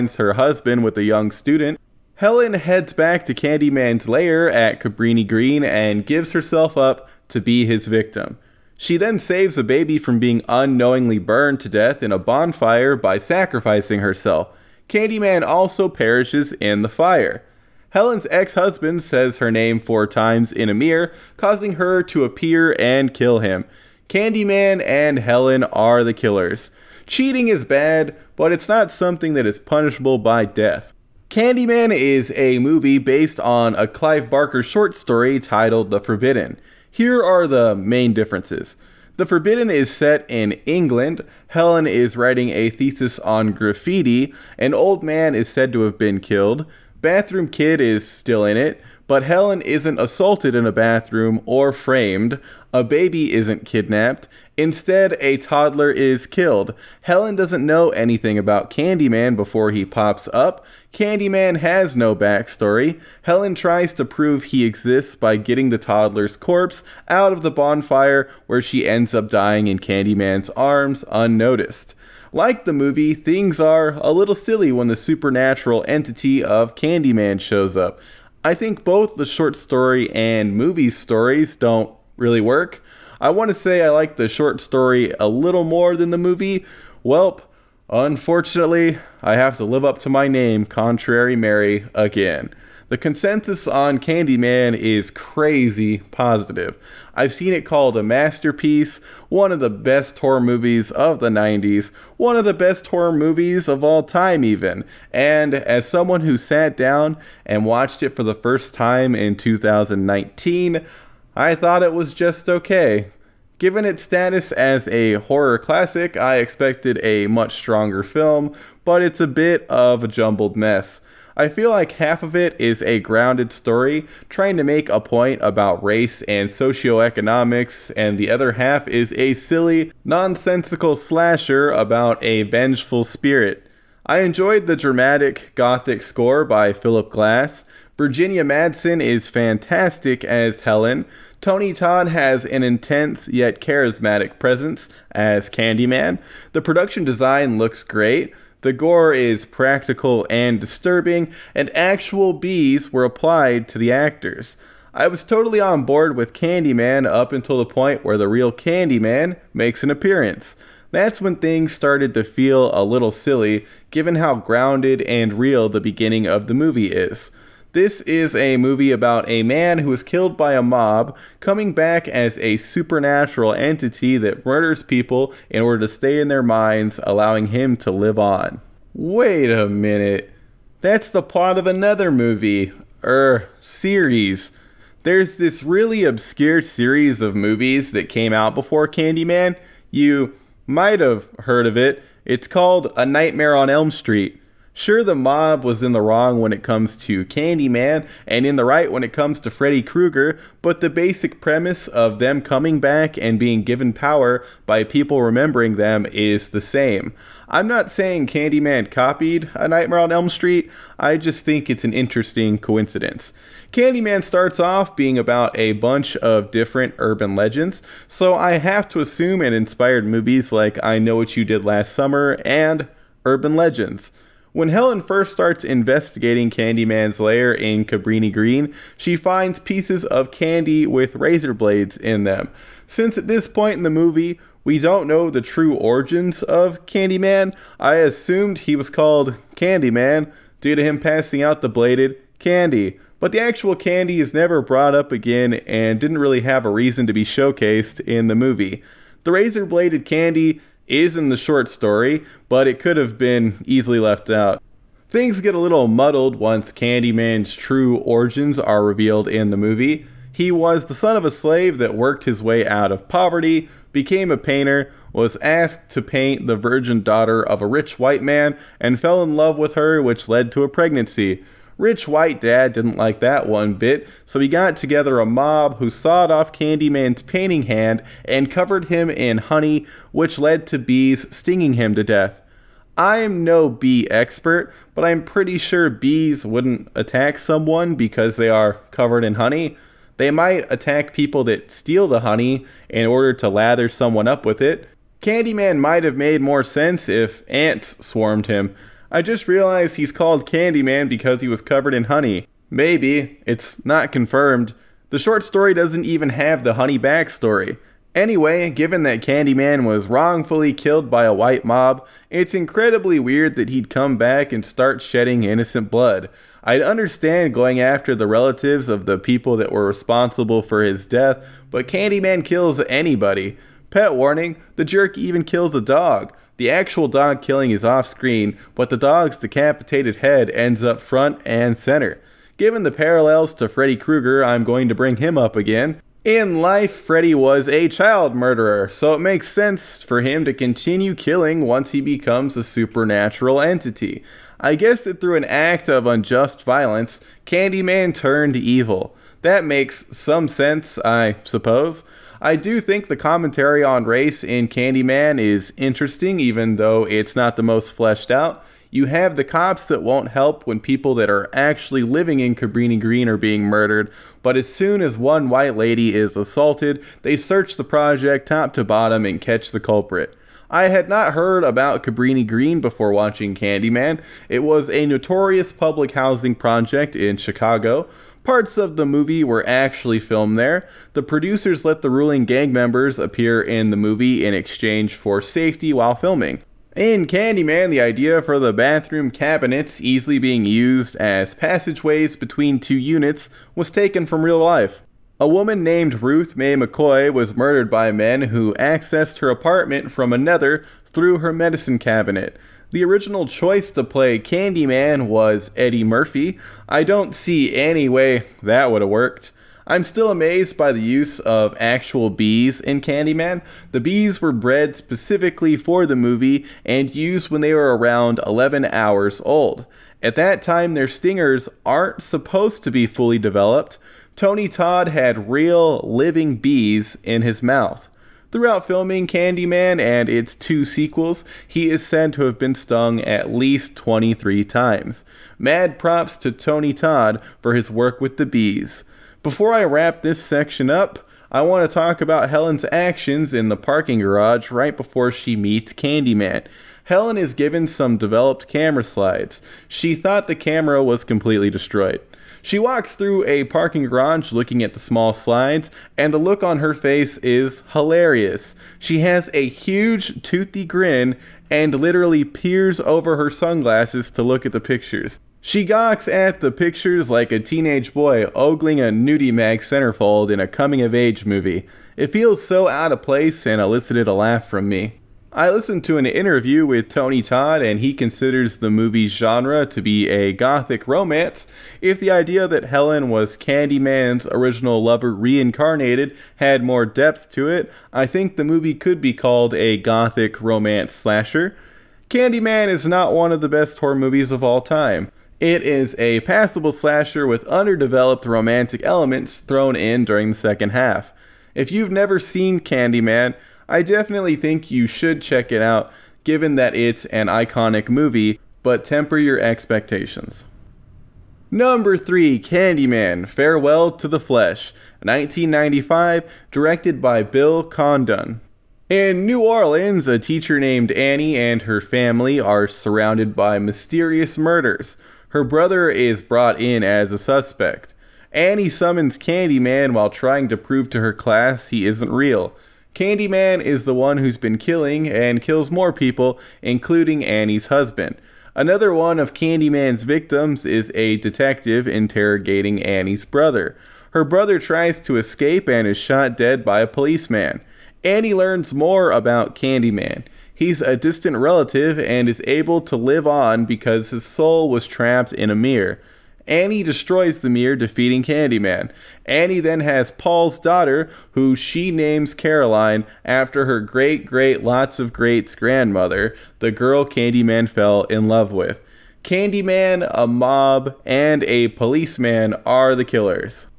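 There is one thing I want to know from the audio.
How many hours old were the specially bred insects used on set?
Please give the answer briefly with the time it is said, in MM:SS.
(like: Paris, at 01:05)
11 hours, at 06:58.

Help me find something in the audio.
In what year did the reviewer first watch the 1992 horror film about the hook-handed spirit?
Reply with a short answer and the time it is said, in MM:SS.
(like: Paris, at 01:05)
2019, at 01:49.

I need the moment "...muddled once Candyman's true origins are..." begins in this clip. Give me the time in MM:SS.
04:15.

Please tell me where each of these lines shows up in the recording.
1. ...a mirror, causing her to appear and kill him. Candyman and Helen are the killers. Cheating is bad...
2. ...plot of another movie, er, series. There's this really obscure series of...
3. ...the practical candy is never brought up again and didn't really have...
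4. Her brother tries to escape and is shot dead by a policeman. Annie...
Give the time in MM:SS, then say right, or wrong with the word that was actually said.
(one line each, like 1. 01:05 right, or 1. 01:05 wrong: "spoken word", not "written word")
1. 00:20 right
2. 03:01 right
3. 04:03 wrong: "actual", not "practical"
4. 09:04 right.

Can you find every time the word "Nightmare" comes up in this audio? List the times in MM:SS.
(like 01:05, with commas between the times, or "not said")
03:13, 03:29.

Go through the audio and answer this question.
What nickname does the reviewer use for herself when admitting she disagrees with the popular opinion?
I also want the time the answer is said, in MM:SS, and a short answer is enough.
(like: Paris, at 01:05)
Contrary Mary, at 01:30.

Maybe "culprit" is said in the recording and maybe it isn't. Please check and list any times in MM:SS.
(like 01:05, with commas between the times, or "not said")
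06:09.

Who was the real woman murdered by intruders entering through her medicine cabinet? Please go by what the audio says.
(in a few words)
Ruth Mae McCoy.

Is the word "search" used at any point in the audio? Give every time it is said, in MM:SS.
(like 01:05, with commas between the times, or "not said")
06:07.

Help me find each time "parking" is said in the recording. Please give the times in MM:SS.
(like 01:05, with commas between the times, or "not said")
07:23, 07:33.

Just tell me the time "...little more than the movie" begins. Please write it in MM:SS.
01:25.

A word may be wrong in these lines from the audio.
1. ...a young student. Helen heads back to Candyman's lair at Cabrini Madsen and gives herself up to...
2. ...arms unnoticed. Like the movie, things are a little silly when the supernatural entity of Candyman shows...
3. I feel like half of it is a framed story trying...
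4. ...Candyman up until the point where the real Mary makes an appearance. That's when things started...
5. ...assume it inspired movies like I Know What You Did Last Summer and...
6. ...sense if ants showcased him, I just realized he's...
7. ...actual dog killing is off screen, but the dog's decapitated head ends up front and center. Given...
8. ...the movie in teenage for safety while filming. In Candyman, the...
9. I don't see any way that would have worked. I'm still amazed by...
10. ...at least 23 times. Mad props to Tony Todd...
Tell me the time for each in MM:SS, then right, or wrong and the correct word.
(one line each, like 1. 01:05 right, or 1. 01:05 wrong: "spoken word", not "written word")
1. 00:00 wrong: "Green", not "Madsen"
2. 01:10 right
3. 02:01 wrong: "grounded", not "framed"
4. 02:36 wrong: "Candyman", not "Mary"
5. 03:38 right
6. 04:56 wrong: "swarmed", not "showcased"
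7. 05:26 right
8. 06:23 wrong: "exchange", not "teenage"
9. 06:46 right
10. 07:13 right.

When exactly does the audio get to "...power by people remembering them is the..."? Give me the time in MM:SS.
03:23.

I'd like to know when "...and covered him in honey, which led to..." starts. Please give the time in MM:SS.
04:38.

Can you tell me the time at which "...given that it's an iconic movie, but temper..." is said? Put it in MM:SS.
08:26.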